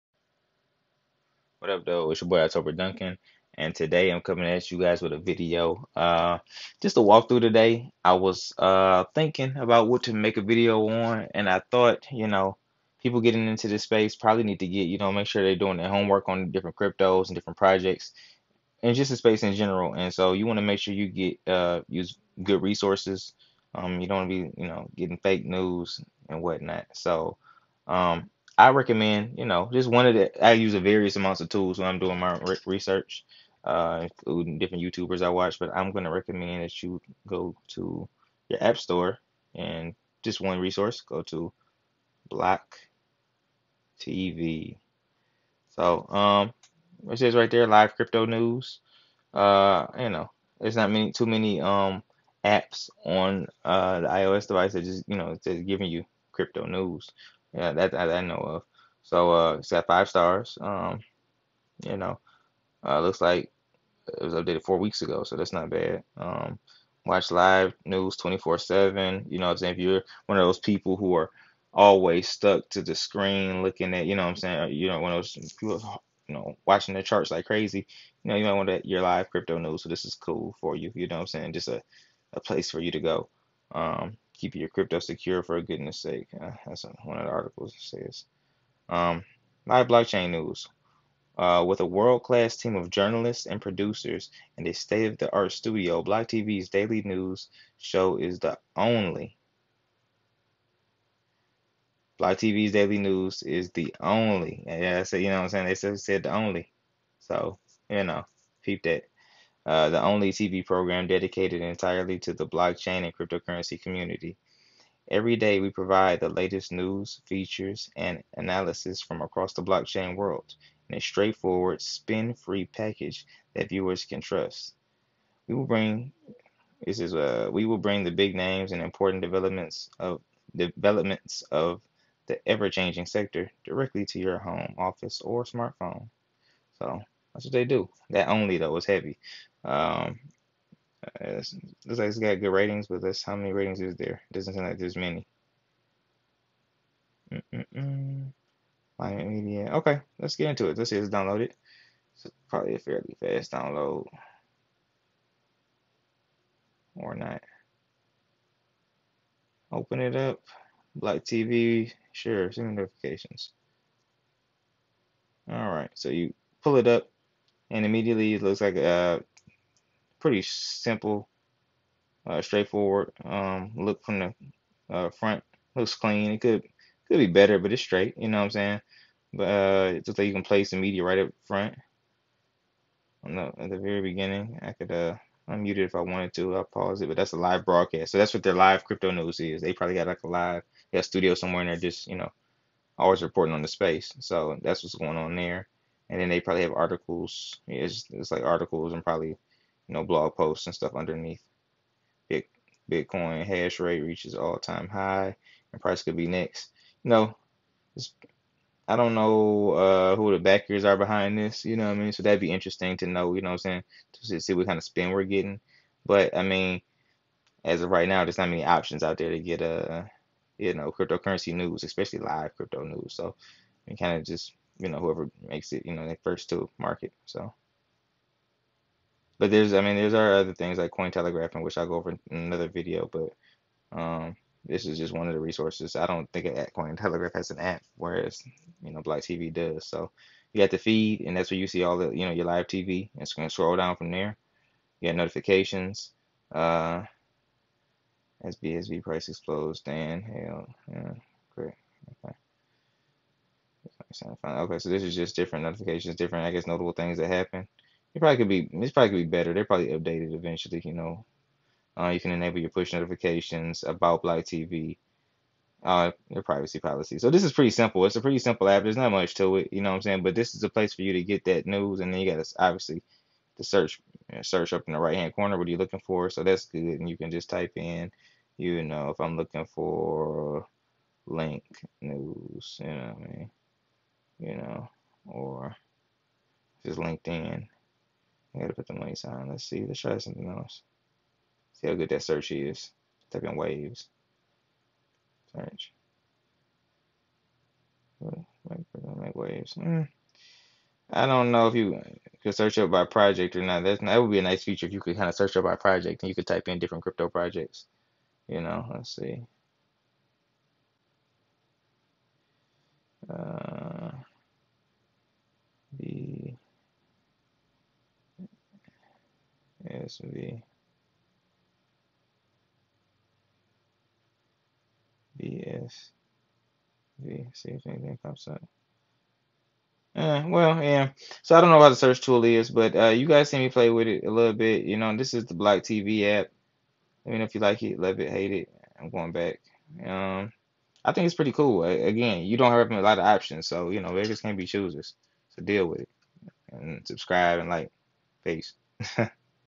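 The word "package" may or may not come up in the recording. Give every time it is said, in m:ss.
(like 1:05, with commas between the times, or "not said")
2:02.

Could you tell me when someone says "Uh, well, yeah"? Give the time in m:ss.
5:30.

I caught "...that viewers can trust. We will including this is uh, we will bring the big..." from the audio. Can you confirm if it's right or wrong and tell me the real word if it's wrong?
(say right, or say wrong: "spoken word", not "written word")
wrong: "bring", not "including".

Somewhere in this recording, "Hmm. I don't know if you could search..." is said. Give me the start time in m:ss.
4:59.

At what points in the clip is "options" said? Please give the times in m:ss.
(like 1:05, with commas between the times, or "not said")
3:38, 5:43.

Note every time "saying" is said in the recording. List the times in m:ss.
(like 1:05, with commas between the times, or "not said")
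1:09, 1:14, 1:21, 1:45, 2:58, 3:33, 4:30.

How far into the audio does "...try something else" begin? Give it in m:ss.
4:49.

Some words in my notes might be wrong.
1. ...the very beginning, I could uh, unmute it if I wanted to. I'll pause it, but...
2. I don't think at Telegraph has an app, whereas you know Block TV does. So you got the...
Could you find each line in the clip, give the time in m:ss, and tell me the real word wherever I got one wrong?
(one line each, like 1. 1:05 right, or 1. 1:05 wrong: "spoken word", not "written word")
1. 3:03 right
2. 3:55 right.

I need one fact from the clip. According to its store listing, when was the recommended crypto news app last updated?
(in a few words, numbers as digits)
4 weeks ago.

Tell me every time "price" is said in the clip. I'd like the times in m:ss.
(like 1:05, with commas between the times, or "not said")
3:25, 4:09.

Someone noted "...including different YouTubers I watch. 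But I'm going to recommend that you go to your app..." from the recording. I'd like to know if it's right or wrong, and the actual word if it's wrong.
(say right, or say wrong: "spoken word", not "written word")
right.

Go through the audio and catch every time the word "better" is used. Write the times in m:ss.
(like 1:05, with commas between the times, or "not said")
2:57, 4:19.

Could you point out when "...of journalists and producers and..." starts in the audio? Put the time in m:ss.
1:32.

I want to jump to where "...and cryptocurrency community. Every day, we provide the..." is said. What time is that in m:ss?
1:53.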